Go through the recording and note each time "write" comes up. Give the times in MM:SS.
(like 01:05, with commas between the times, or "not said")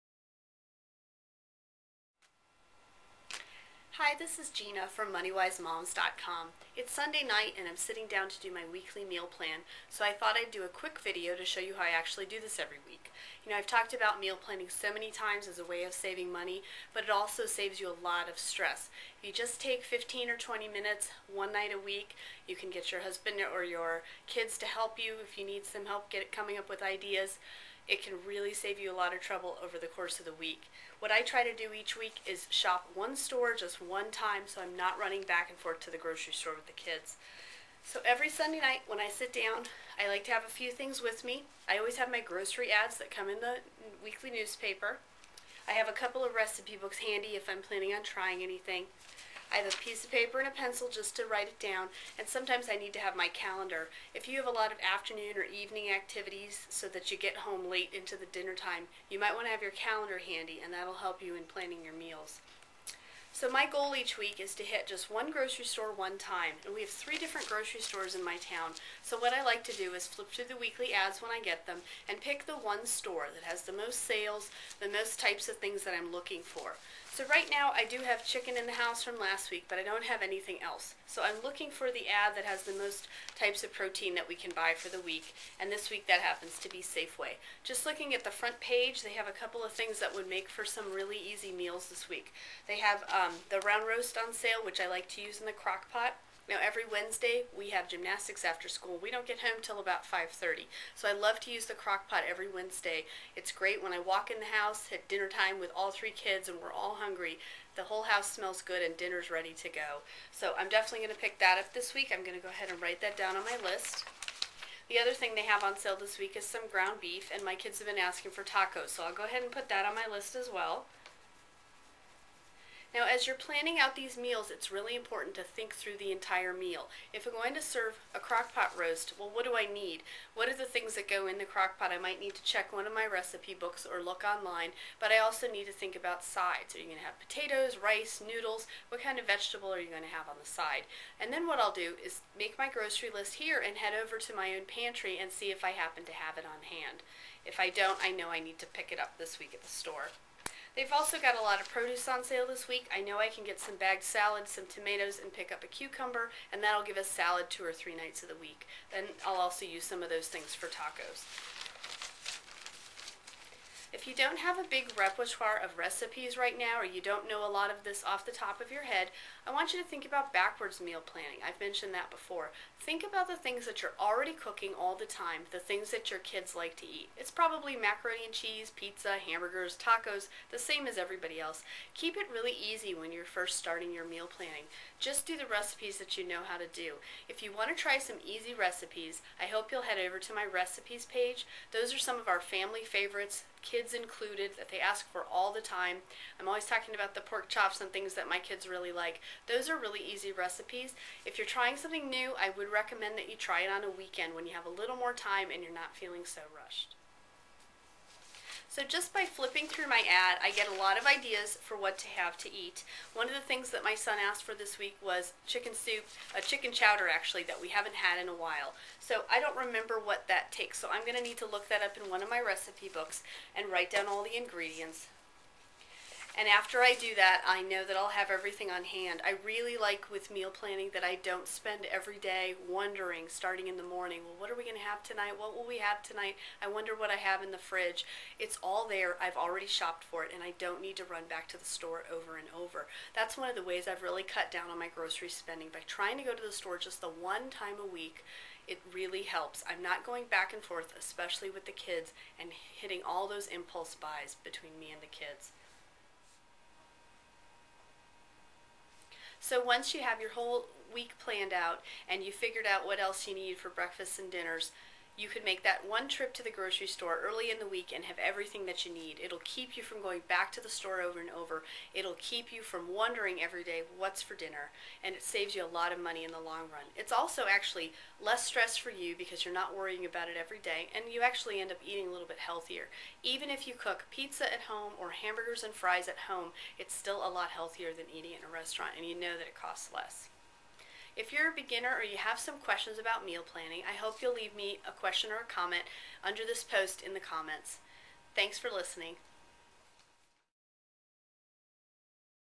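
00:51, 01:52, 03:43.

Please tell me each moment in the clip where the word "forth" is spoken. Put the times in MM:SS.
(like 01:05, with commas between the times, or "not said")
00:35, 04:10.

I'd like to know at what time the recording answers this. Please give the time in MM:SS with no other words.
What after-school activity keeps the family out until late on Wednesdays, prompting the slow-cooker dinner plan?
01:37.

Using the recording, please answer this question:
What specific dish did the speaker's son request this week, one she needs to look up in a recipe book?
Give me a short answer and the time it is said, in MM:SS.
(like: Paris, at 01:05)
Chicken chowder, at 03:36.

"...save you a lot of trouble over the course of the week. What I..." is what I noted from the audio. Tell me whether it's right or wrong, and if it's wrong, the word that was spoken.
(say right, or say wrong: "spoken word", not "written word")
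right.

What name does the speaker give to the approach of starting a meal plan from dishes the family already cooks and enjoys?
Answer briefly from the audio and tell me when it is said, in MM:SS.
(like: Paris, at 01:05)
Backwards meal planning, at 02:50.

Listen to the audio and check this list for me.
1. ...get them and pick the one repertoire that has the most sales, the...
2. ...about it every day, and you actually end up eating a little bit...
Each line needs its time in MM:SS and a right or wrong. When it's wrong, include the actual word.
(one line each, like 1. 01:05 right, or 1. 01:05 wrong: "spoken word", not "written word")
1. 01:11 wrong: "store", not "repertoire"
2. 04:40 right.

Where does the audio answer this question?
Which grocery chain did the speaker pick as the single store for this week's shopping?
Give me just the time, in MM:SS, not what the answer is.
01:26.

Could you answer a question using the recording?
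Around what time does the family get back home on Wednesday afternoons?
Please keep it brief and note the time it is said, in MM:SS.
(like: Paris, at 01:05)
5:30, at 01:40.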